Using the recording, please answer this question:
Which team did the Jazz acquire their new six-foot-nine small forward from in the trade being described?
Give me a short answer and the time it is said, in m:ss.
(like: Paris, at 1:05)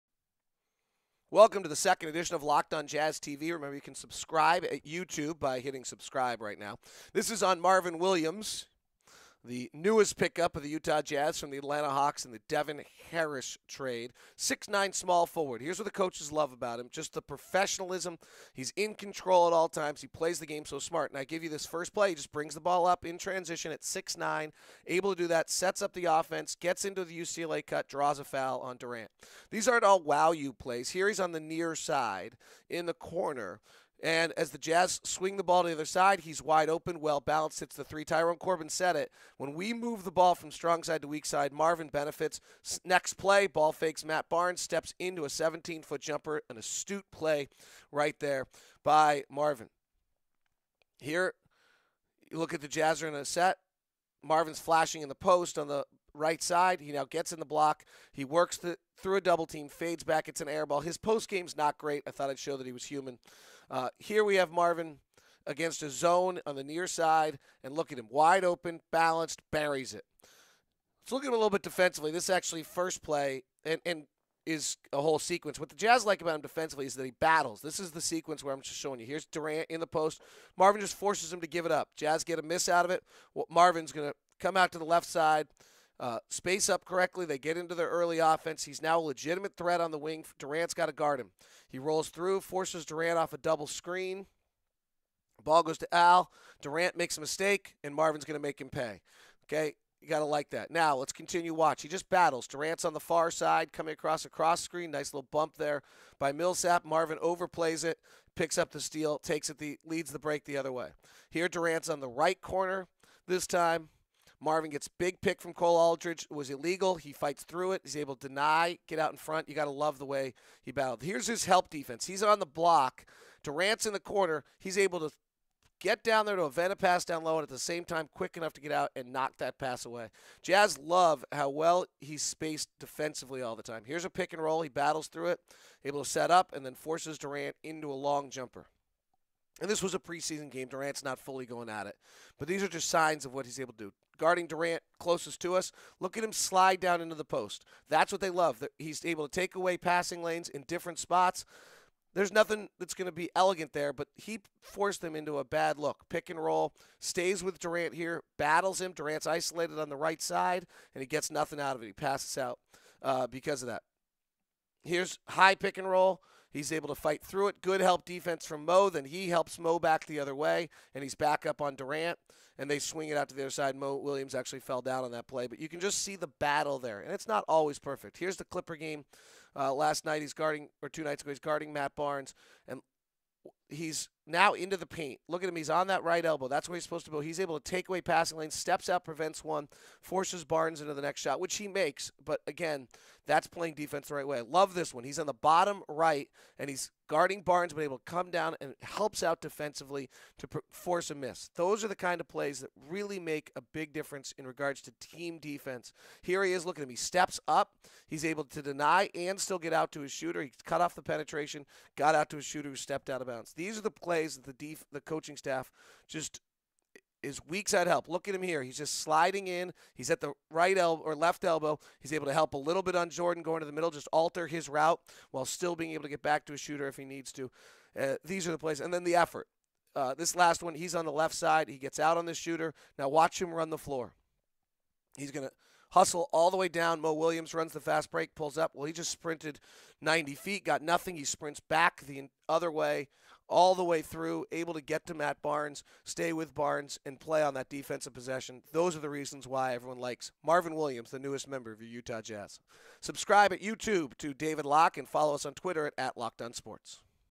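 Atlanta Hawks, at 0:11.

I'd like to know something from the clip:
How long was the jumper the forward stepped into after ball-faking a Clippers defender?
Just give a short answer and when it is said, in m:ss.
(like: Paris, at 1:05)
17 foot, at 0:45.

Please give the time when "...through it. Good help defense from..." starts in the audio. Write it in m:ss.
2:47.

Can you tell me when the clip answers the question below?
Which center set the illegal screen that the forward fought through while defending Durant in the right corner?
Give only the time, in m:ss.
1:55.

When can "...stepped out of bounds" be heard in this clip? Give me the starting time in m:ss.
3:32.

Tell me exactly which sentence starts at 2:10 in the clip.
Jazz love how well he's spaced defensively all the time.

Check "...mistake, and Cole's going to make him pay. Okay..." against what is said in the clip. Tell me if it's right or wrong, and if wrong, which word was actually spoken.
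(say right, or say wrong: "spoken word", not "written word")
wrong: "Marvin", not "Cole".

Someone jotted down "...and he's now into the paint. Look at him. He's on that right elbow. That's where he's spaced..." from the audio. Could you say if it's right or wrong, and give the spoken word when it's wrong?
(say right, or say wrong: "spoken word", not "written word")
wrong: "supposed", not "spaced".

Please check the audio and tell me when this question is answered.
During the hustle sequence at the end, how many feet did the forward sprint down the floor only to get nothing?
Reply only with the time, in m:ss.
4:00.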